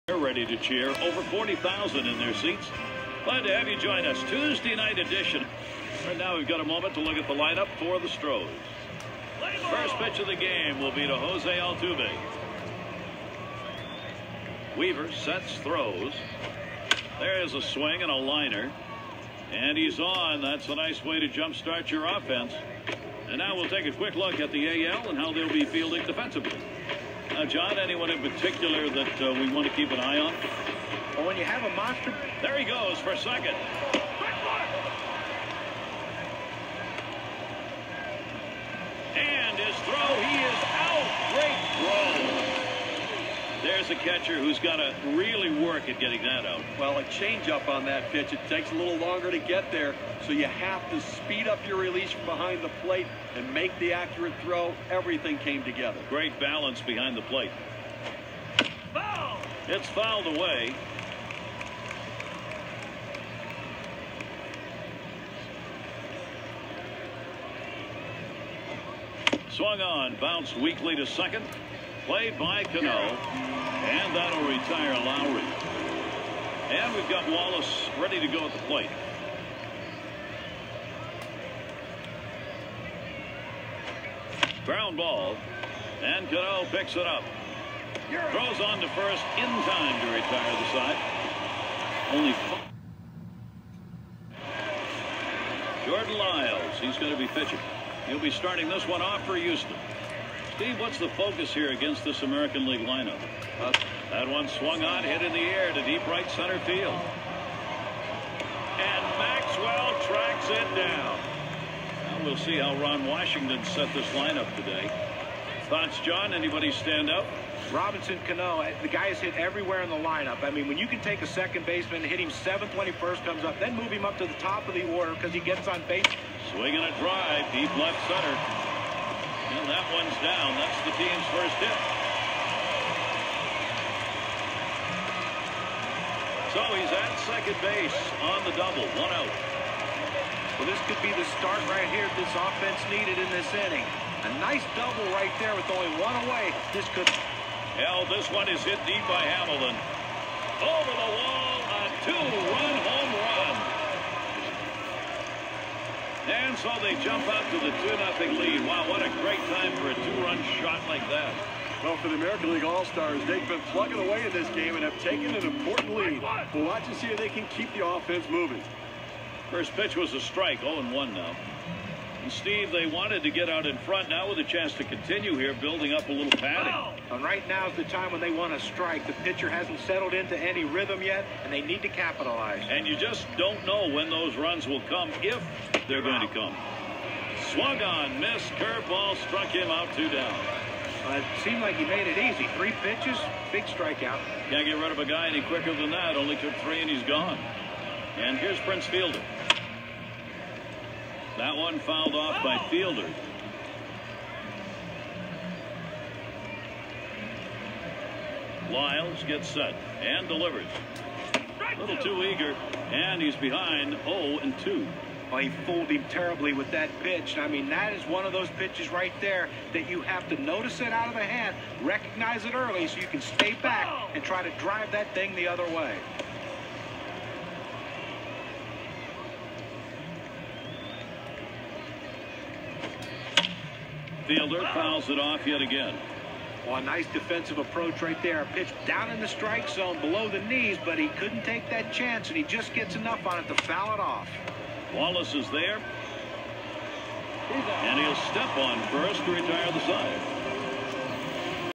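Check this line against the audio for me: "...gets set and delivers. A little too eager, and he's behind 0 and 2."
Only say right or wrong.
right.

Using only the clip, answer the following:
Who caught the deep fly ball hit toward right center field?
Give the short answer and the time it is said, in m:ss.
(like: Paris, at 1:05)
Maxwell, at 1:49.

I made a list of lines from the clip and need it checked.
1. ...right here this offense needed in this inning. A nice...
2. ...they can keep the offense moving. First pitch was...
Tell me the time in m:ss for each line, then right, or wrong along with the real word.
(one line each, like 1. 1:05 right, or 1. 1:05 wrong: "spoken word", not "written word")
1. 2:21 right
2. 2:47 right.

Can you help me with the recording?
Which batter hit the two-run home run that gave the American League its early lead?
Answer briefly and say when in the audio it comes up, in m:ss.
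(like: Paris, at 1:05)
Hamilton, at 2:29.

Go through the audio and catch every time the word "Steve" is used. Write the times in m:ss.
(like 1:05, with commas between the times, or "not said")
1:40, 2:52.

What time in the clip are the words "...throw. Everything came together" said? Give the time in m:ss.
0:54.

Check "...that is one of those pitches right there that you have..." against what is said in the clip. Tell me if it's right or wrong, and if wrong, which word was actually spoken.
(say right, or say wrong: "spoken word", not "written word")
right.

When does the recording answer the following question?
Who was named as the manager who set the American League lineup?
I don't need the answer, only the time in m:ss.
1:52.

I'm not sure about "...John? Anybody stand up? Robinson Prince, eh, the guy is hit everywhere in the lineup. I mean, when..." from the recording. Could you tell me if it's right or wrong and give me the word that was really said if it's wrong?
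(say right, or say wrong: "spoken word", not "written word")
wrong: "Cano", not "Prince".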